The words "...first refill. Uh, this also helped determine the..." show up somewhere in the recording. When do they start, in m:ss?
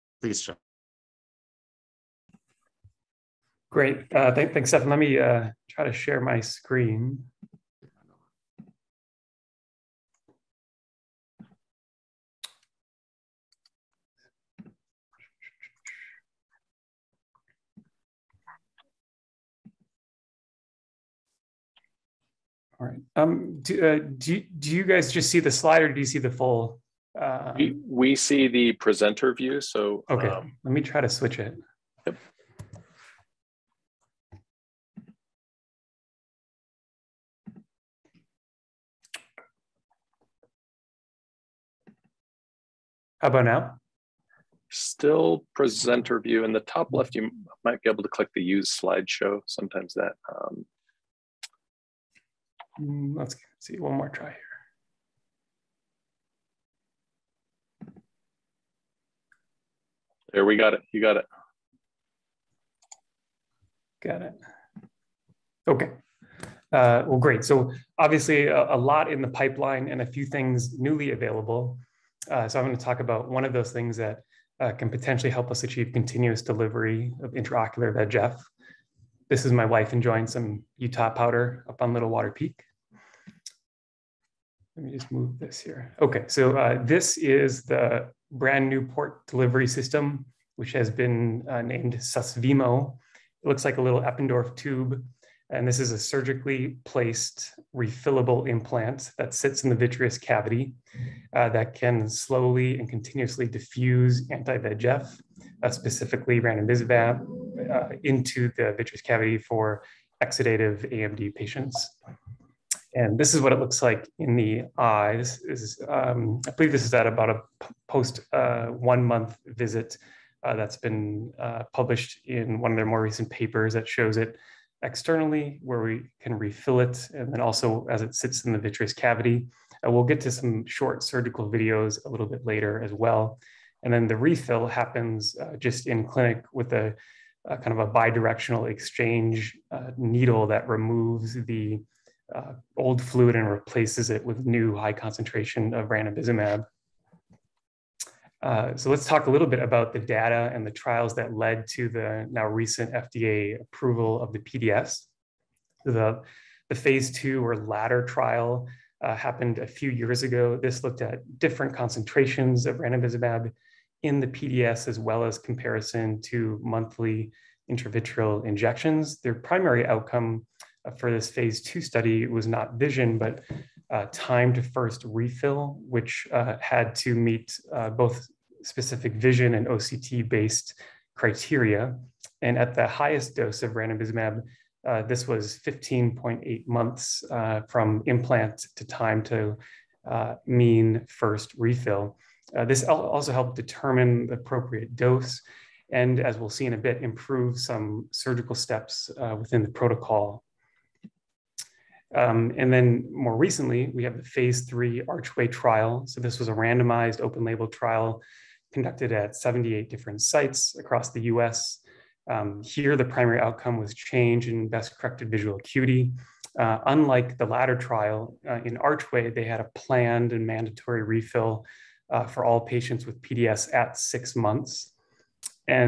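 3:11.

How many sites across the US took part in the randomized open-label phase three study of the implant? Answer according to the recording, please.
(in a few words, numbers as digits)
78.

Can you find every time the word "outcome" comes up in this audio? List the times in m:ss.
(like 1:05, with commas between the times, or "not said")
2:49, 3:33.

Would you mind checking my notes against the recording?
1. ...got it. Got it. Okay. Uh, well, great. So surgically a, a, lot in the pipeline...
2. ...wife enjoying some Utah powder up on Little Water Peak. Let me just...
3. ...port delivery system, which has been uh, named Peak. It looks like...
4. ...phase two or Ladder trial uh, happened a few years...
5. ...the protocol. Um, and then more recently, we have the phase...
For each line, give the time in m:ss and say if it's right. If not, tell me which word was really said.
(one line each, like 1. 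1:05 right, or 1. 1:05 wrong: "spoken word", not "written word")
1. 1:01 wrong: "obviously", not "surgically"
2. 1:19 right
3. 1:28 wrong: "Susvimo", not "Peak"
4. 2:36 right
5. 3:19 right.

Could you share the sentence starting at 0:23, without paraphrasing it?
Um, do, uh, do, do you guys just see the slide or do you see the full?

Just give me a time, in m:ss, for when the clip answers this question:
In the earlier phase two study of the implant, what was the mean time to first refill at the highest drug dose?
3:05.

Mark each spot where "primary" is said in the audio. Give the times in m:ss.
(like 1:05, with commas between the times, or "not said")
2:49, 3:33.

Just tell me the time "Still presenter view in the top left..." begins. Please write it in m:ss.
0:44.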